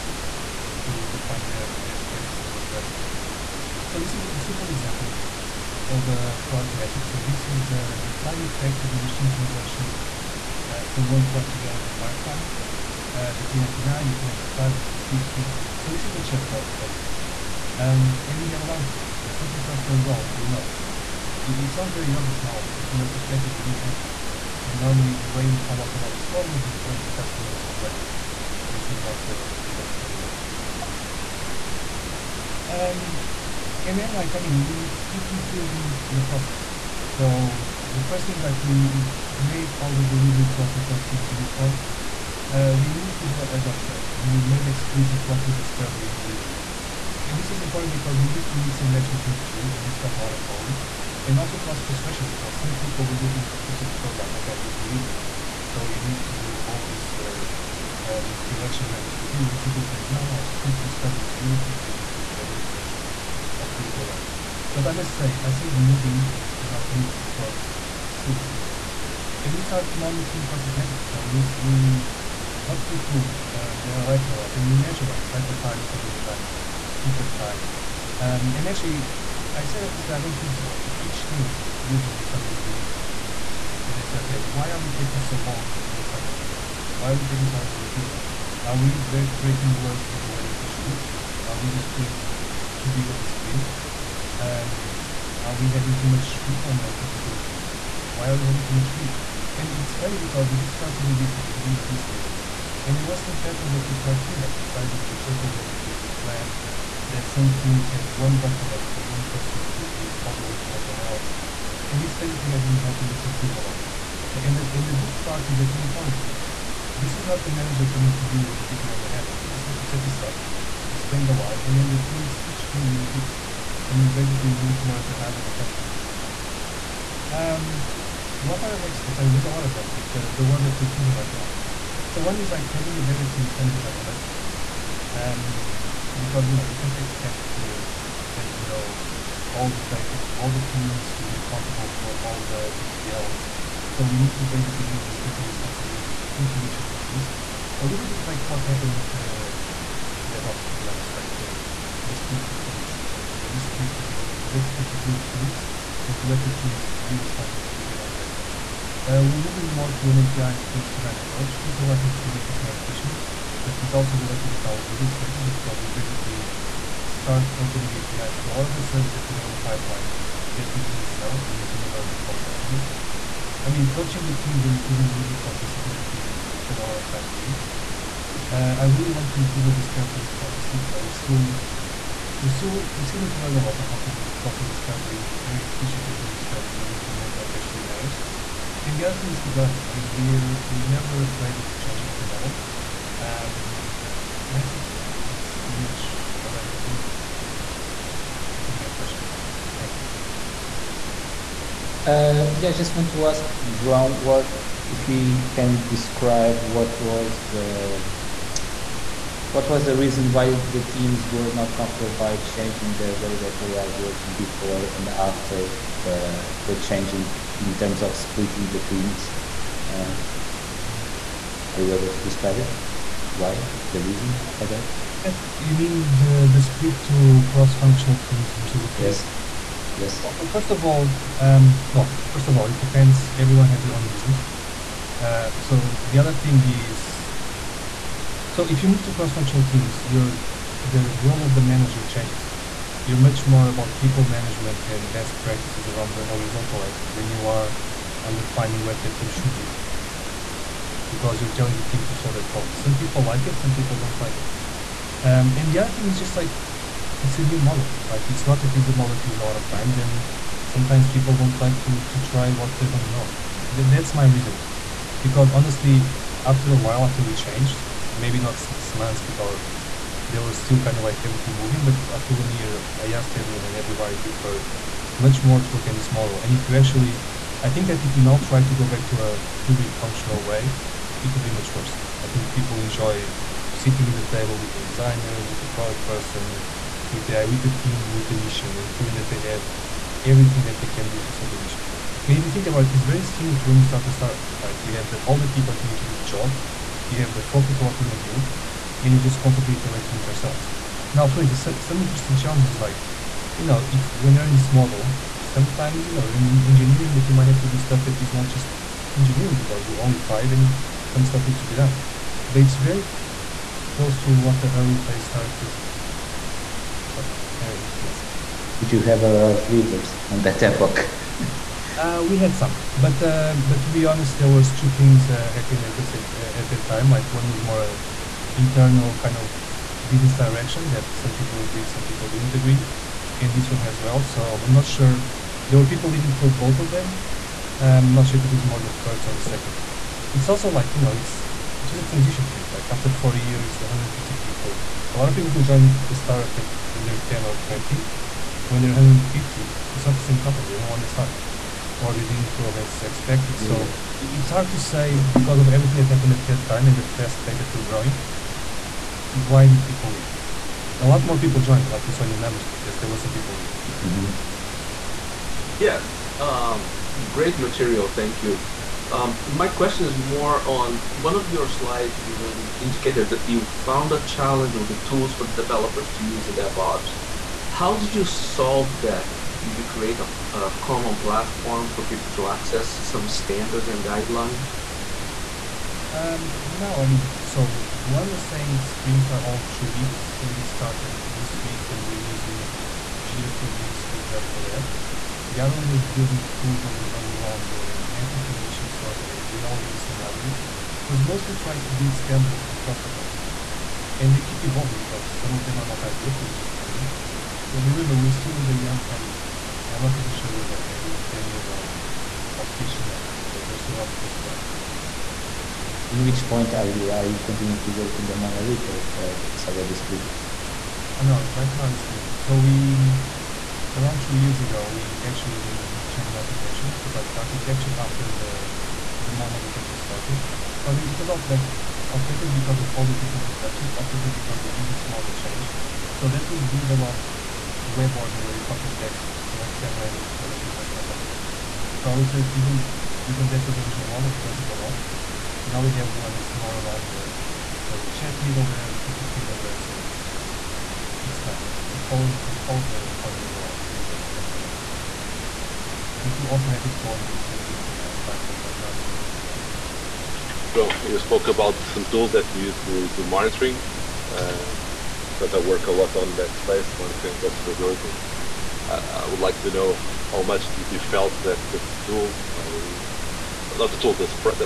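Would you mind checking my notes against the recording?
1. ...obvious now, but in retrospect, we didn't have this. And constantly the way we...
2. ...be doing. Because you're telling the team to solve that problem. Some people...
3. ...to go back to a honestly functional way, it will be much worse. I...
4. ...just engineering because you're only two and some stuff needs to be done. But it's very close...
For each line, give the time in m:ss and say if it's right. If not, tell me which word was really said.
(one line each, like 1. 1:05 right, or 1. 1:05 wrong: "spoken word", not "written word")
1. 0:22 wrong: "normally", not "constantly"
2. 4:09 right
3. 4:38 wrong: "purely", not "honestly"
4. 5:08 wrong: "five", not "two".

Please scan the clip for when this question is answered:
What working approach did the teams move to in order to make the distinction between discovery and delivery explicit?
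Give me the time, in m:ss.
0:43.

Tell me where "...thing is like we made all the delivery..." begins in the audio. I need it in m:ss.
0:38.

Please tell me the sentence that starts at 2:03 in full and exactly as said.
And we basically look more at the high level patterns.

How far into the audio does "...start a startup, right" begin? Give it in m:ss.
4:53.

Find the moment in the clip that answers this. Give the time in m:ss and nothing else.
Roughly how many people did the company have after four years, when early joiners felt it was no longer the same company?
5:43.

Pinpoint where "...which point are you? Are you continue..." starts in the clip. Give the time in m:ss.
6:56.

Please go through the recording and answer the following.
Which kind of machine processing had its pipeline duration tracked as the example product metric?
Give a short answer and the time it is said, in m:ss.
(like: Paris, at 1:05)
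machine translation, at 0:08.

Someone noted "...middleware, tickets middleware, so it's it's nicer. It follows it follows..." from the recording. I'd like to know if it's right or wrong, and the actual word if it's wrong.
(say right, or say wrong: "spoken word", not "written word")
right.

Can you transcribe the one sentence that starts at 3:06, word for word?
So we implement what actually matters.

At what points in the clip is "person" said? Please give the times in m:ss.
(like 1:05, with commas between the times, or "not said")
1:49, 4:46.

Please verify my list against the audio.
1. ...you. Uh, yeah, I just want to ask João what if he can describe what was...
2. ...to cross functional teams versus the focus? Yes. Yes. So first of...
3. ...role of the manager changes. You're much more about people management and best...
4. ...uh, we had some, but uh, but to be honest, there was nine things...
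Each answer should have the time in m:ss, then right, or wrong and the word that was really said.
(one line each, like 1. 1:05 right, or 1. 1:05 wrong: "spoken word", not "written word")
1. 3:19 right
2. 3:47 wrong: "previous", not "focus"
3. 4:01 right
4. 5:21 wrong: "two", not "nine".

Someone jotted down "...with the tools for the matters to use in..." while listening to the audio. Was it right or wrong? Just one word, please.
wrong.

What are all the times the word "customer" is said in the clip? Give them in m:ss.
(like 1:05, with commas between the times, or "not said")
0:27, 2:52.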